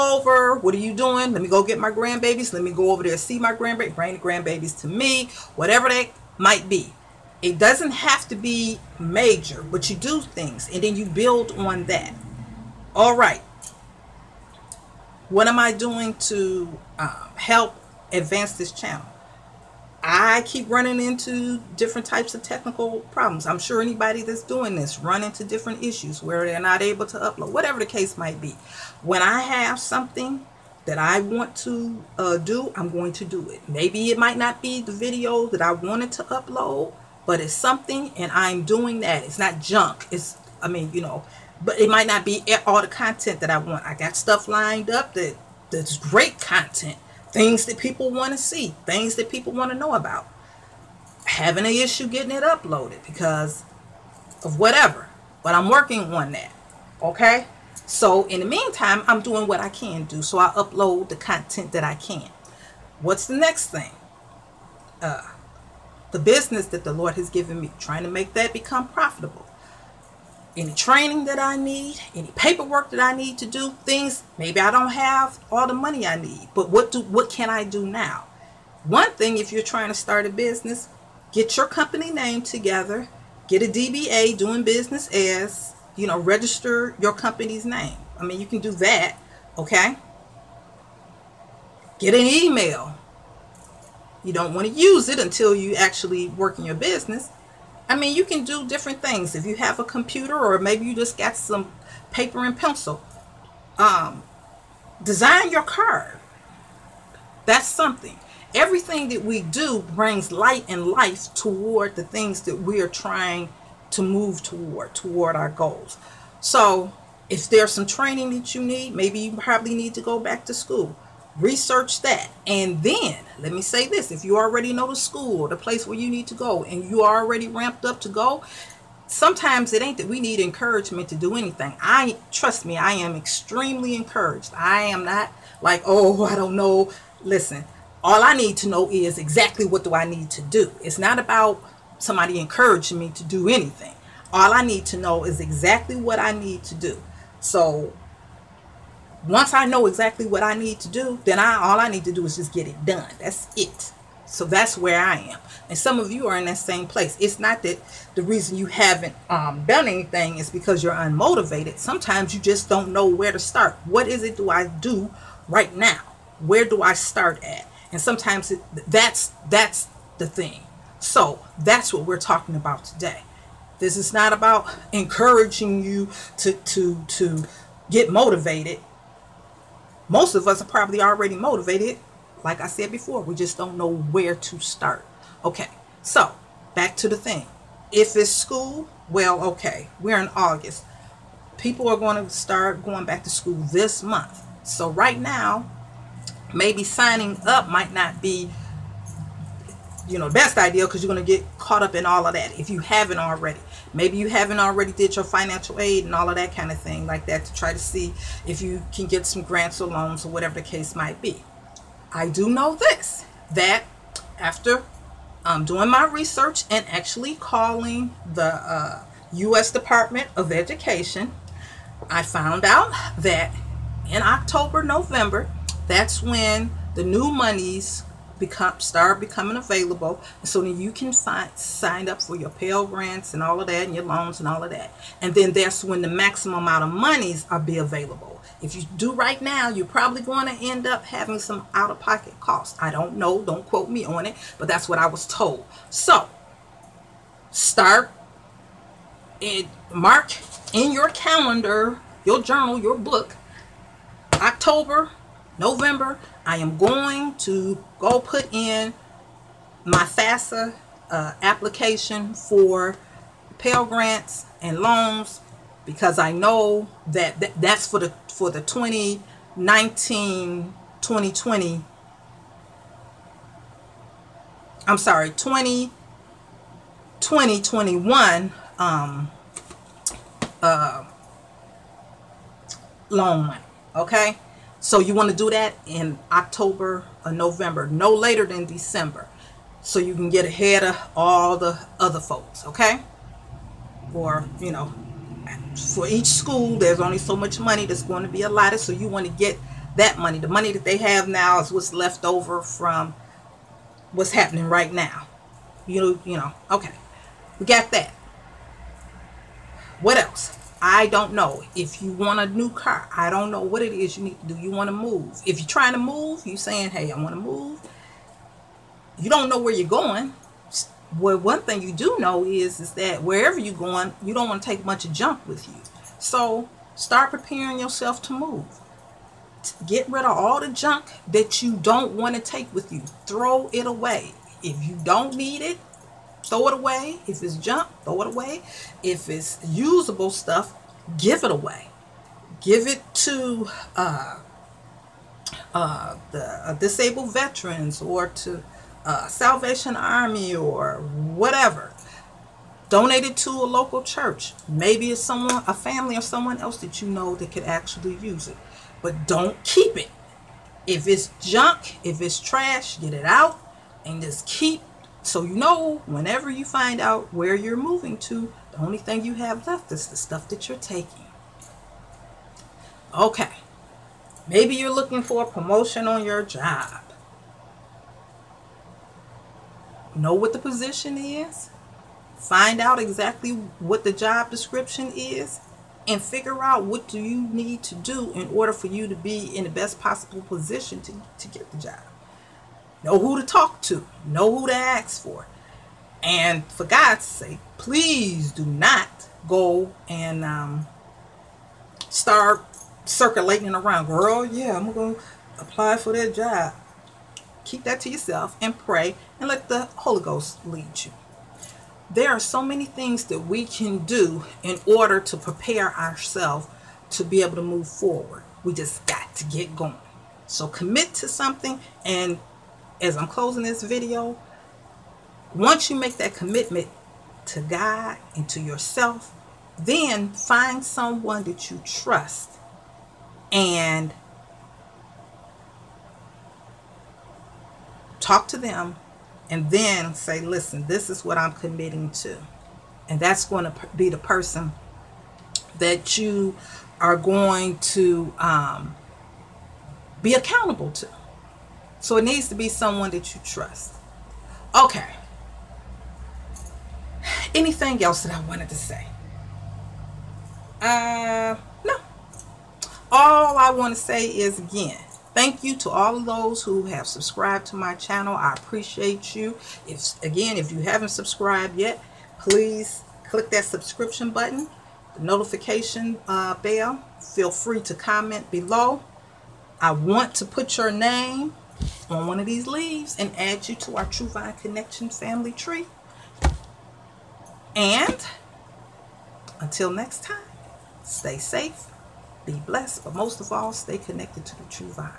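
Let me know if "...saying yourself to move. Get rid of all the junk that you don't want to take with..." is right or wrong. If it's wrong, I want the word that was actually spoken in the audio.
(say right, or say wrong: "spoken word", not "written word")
wrong: "preparing", not "saying".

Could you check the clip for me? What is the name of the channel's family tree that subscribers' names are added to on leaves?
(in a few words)
True Vine Connection.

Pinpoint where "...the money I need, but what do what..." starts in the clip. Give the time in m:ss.
1:15.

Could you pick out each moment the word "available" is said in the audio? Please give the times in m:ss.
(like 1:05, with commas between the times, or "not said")
3:49, 3:57.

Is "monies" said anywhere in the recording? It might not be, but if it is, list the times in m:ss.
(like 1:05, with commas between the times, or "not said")
3:47, 3:56.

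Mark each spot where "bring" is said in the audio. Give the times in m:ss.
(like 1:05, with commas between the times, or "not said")
0:03, 1:49.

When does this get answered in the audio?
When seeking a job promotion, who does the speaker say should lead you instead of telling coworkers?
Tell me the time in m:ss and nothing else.
6:49.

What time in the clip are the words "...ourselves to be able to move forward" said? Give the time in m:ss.
6:55.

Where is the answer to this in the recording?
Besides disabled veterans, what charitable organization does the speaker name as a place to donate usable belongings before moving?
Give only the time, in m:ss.
5:49.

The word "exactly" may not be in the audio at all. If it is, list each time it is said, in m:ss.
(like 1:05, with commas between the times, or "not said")
2:19, 2:25, 2:29, 6:22.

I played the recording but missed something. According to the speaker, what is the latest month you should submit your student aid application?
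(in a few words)
December.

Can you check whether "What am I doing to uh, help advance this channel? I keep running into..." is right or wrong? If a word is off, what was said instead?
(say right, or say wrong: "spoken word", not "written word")
right.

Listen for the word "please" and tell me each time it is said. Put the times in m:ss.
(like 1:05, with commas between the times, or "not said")
6:37, 7:52.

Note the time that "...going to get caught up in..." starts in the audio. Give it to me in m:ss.
3:21.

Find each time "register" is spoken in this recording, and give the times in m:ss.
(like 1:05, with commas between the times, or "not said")
1:26.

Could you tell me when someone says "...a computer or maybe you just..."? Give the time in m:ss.
1:39.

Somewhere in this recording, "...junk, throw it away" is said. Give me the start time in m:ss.
5:37.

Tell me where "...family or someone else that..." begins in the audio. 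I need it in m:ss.
5:55.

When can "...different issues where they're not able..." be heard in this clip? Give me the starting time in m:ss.
0:25.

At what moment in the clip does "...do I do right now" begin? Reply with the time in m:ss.
2:44.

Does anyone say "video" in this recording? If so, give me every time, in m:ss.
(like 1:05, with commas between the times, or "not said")
0:34, 7:03.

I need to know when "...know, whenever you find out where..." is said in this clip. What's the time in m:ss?
6:05.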